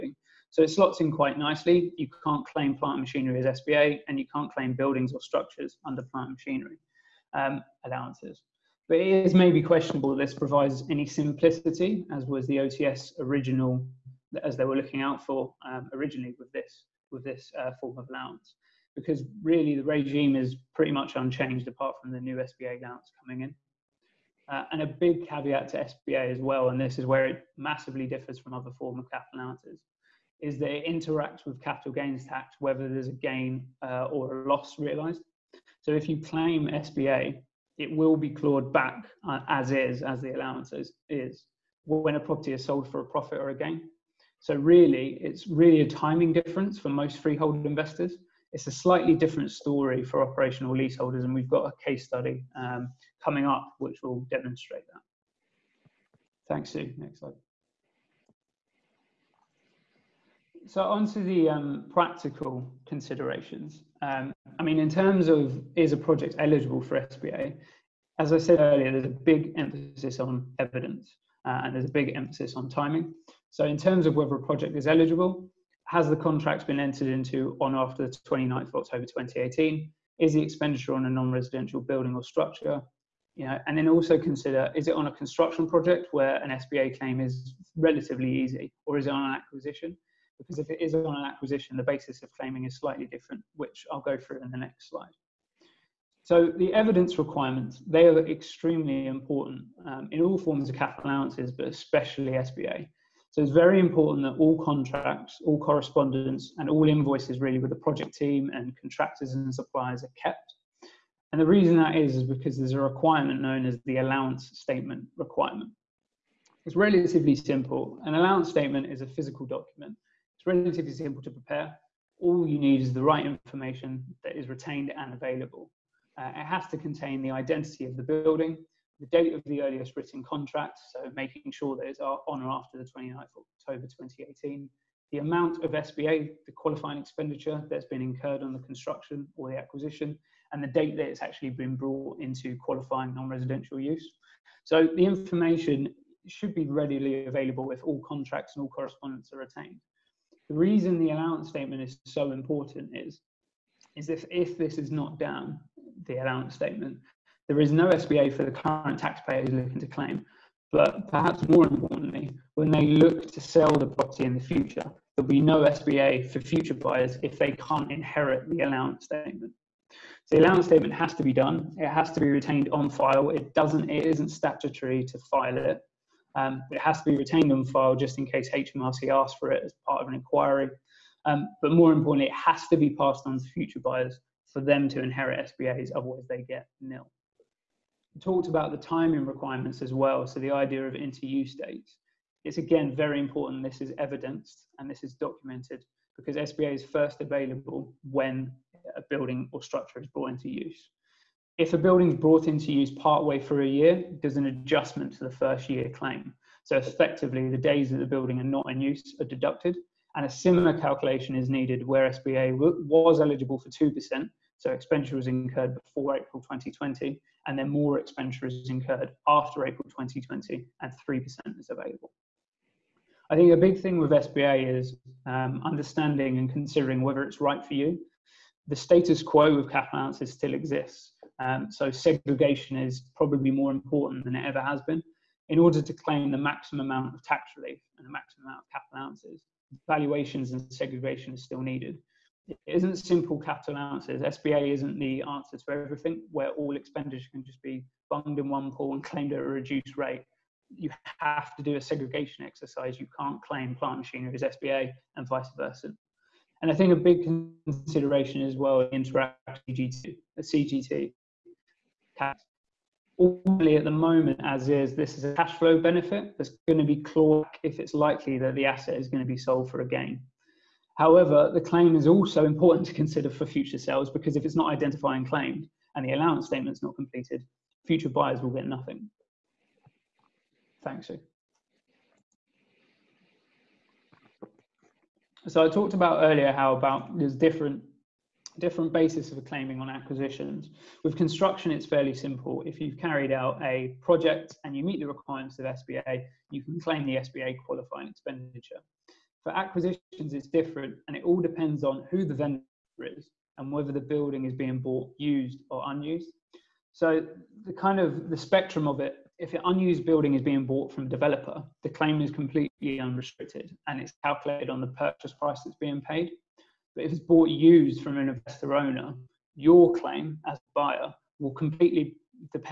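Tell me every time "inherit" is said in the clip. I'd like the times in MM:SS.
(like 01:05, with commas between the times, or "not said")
02:47, 03:05.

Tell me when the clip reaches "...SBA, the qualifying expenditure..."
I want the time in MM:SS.
02:15.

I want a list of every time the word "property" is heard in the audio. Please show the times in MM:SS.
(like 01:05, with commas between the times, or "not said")
00:42, 02:43.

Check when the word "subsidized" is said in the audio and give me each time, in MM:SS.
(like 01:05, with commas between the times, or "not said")
not said.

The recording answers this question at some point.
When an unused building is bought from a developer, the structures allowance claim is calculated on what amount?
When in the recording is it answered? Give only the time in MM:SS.
05:14.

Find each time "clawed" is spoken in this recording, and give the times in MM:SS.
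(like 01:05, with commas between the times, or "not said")
00:38, 04:26.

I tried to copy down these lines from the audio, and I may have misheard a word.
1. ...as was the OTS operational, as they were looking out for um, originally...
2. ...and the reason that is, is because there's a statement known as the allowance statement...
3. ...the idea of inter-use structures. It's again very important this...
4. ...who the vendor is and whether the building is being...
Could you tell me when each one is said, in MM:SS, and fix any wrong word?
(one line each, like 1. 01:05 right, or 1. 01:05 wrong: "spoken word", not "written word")
1. 00:12 wrong: "original", not "operational"
2. 01:51 wrong: "requirement", not "statement"
3. 03:10 wrong: "dates", not "structures"
4. 05:02 right.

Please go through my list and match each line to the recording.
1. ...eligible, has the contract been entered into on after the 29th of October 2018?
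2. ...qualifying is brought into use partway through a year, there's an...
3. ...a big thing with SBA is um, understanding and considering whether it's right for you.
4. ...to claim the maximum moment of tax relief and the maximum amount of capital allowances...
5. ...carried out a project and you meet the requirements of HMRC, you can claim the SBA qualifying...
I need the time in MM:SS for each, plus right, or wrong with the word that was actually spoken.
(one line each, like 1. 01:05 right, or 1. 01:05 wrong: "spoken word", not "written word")
1. 01:14 right
2. 03:21 wrong: "building", not "qualifying"
3. 03:43 right
4. 03:55 wrong: "amount", not "moment"
5. 04:52 wrong: "SBA", not "HMRC".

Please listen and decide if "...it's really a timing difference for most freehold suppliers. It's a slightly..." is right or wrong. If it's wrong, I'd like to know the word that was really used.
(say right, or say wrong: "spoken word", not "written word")
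wrong: "investors", not "suppliers".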